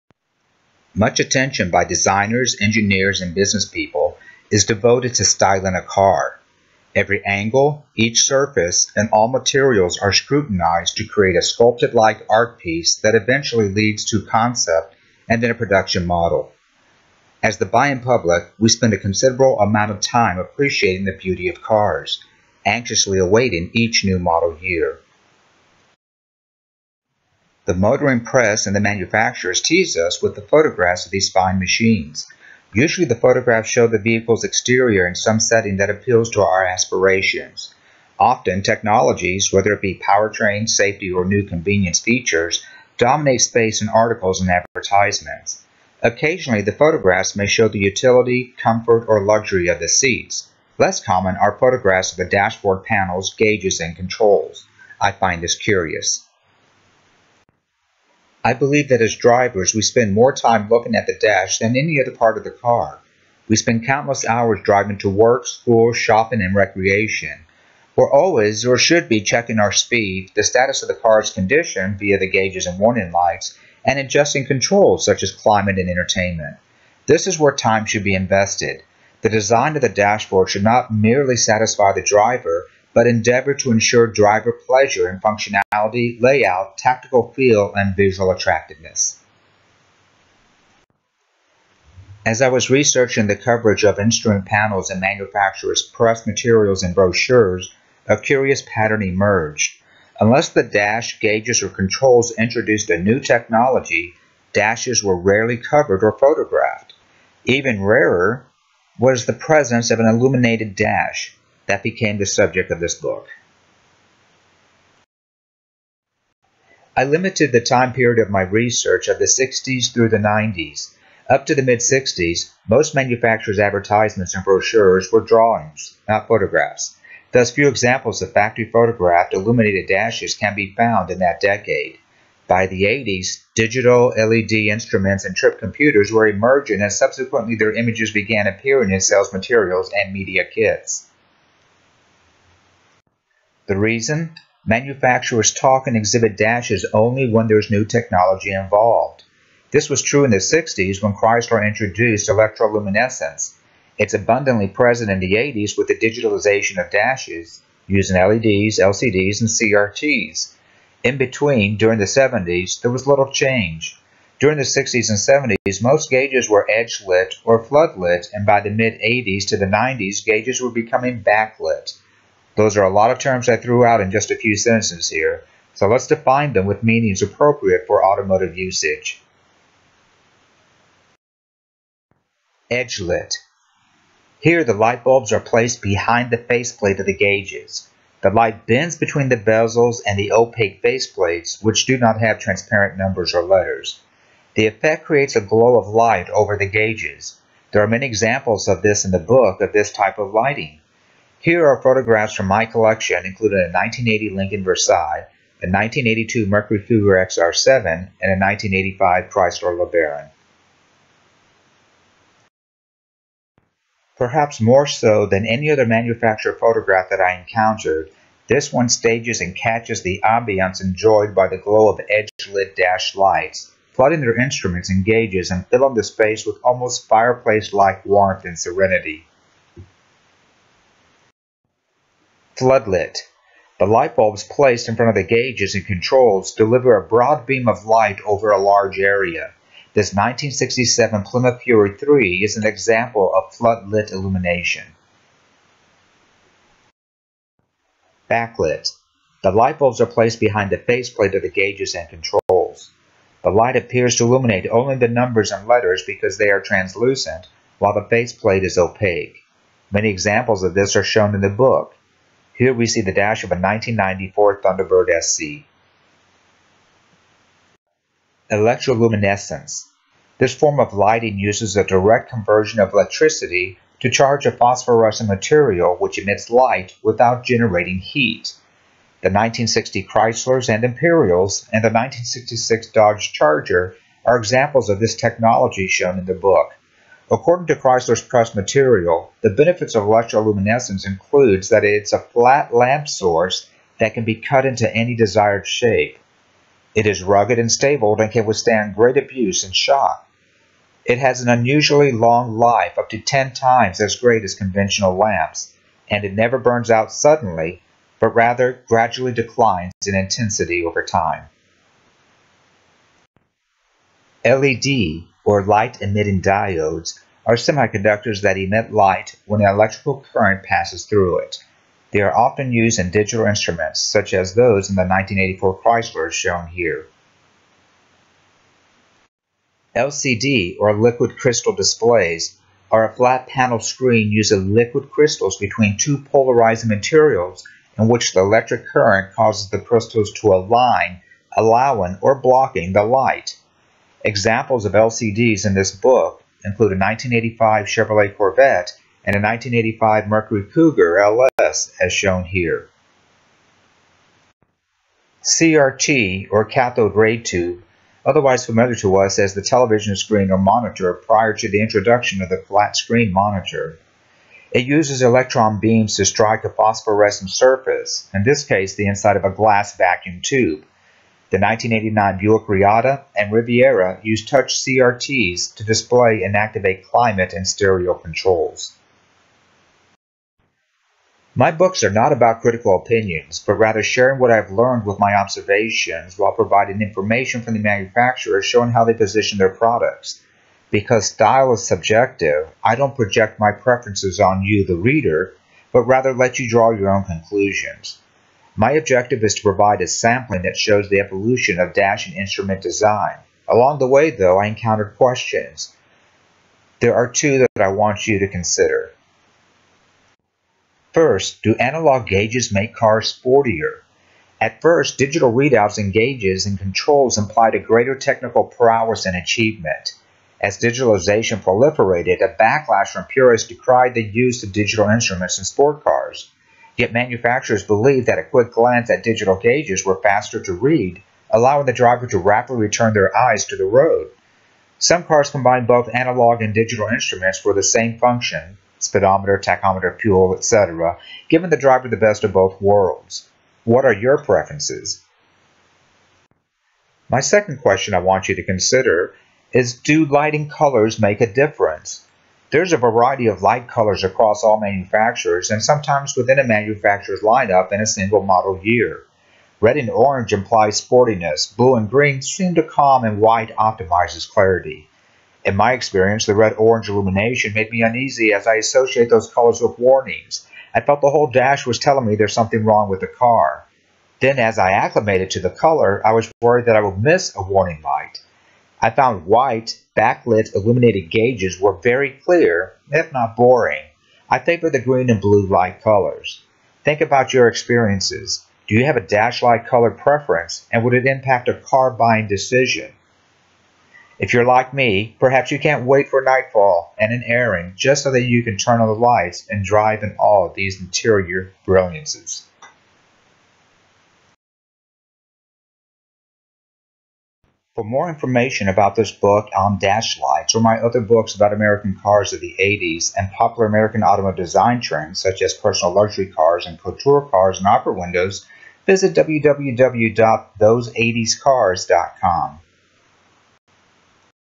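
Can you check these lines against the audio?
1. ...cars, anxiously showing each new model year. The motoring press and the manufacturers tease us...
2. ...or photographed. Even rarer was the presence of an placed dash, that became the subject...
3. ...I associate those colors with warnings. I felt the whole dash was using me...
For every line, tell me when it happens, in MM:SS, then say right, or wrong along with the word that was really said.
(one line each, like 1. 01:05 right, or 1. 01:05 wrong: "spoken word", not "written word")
1. 00:21 wrong: "awaiting", not "showing"
2. 01:46 wrong: "illuminated", not "placed"
3. 07:48 wrong: "telling", not "using".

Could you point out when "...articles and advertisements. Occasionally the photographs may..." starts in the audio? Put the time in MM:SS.
00:43.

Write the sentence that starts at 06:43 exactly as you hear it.
Along the way, though, I encountered questions.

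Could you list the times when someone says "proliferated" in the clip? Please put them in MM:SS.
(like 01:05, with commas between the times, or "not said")
07:01.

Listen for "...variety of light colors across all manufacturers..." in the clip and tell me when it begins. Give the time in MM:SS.
07:33.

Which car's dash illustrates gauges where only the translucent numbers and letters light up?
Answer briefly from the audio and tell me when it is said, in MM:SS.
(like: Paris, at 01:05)
1994 Thunderbird SC, at 04:23.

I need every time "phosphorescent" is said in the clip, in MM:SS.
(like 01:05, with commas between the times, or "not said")
04:34, 06:06.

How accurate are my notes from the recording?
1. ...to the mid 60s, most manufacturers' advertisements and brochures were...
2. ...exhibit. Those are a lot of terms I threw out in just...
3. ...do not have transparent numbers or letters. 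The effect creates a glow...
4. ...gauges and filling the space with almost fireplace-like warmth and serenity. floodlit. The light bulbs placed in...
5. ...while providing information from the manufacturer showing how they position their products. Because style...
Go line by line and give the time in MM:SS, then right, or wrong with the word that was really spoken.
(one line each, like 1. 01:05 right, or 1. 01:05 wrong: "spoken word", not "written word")
1. 02:01 right
2. 02:51 wrong: "backlit", not "exhibit"
3. 03:11 right
4. 03:45 right
5. 06:26 right.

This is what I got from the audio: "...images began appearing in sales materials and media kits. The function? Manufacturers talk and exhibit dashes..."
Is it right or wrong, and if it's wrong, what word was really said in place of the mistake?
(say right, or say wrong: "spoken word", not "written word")
wrong: "reason", not "function".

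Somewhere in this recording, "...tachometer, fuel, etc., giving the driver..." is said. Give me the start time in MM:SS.
07:19.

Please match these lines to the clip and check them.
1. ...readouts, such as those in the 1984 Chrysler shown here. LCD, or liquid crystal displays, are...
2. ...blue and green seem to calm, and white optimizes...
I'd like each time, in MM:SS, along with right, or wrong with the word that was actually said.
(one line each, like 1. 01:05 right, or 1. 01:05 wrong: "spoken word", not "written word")
1. 05:23 wrong: "instruments", not "readouts"
2. 07:41 right.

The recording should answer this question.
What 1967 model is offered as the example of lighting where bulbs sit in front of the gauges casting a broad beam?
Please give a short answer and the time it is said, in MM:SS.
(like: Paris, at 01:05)
1967 Plymouth Fury 3, at 04:00.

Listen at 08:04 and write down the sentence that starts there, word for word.
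I favor the green and blue light colors.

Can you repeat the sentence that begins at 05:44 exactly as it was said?
Examples of LCDs in this book include a 1985 Chevrolet Corvette and a 1985 Mercury Cougar LS as shown here.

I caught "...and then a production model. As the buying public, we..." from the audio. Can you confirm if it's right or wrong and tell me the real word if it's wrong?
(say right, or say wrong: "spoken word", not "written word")
right.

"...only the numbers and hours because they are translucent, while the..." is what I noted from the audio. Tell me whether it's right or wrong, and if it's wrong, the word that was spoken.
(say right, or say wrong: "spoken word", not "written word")
wrong: "letters", not "hours".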